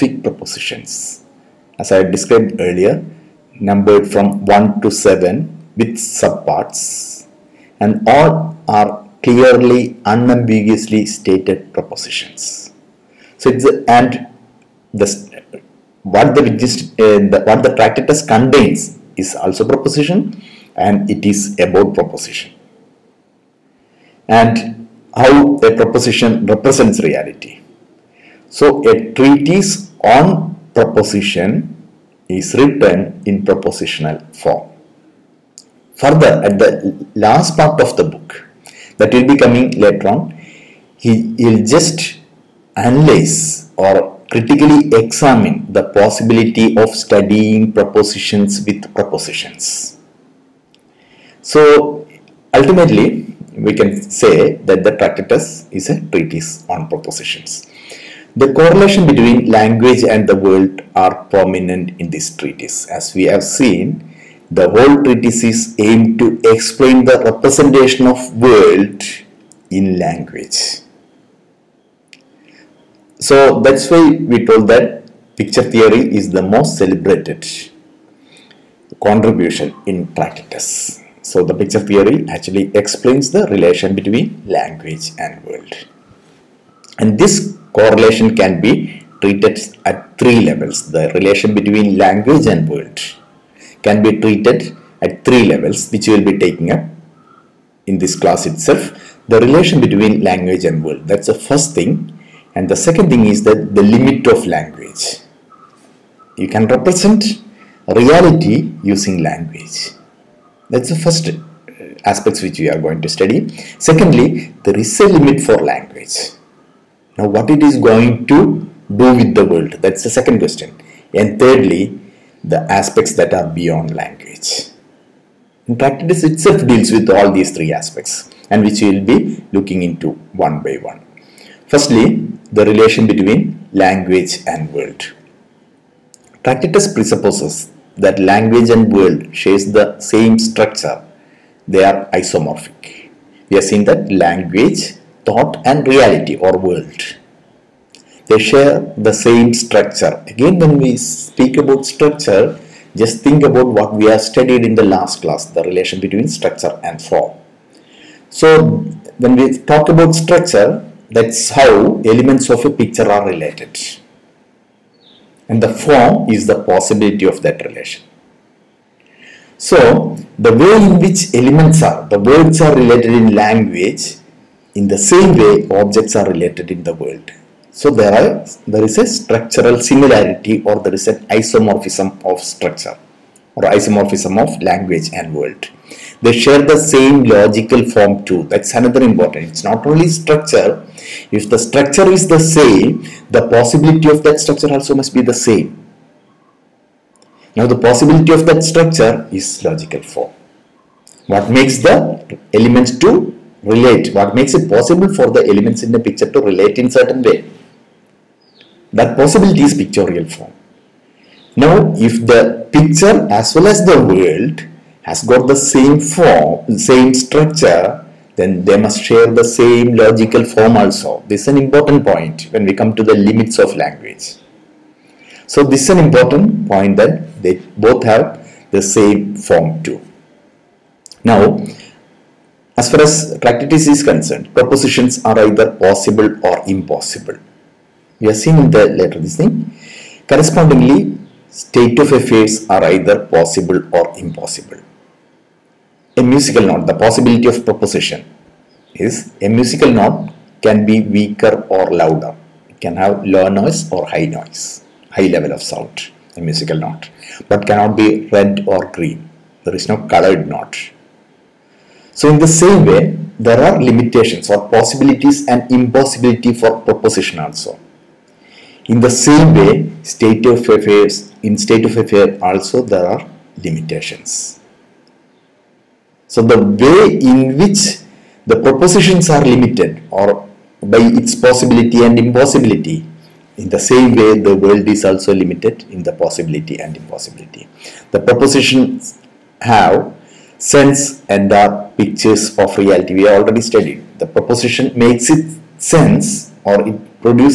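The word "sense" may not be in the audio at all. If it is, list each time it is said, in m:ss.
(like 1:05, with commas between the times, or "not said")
4:50, 4:55.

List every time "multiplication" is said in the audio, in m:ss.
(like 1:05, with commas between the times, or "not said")
not said.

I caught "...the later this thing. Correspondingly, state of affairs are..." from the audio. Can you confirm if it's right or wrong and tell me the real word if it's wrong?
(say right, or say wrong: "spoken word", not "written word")
right.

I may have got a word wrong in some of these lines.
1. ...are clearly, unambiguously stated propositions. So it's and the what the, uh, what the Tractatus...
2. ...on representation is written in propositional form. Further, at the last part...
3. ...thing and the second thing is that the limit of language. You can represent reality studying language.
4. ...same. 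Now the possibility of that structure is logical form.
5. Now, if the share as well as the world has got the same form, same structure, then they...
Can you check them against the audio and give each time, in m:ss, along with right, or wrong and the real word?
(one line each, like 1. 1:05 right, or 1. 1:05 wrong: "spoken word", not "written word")
1. 0:08 right
2. 0:30 wrong: "proposition", not "representation"
3. 1:41 wrong: "using", not "studying"
4. 3:15 right
5. 3:31 wrong: "picture", not "share".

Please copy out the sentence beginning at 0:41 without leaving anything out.
He will just analyze or critically examine the possibility of studying propositions with propositions.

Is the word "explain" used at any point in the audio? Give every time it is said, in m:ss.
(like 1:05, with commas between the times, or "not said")
1:06, 1:22.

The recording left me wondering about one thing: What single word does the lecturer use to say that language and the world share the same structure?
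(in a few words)
Isomorphic.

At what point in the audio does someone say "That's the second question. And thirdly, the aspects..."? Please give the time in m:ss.
1:59.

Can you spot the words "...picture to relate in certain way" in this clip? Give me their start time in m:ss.
3:25.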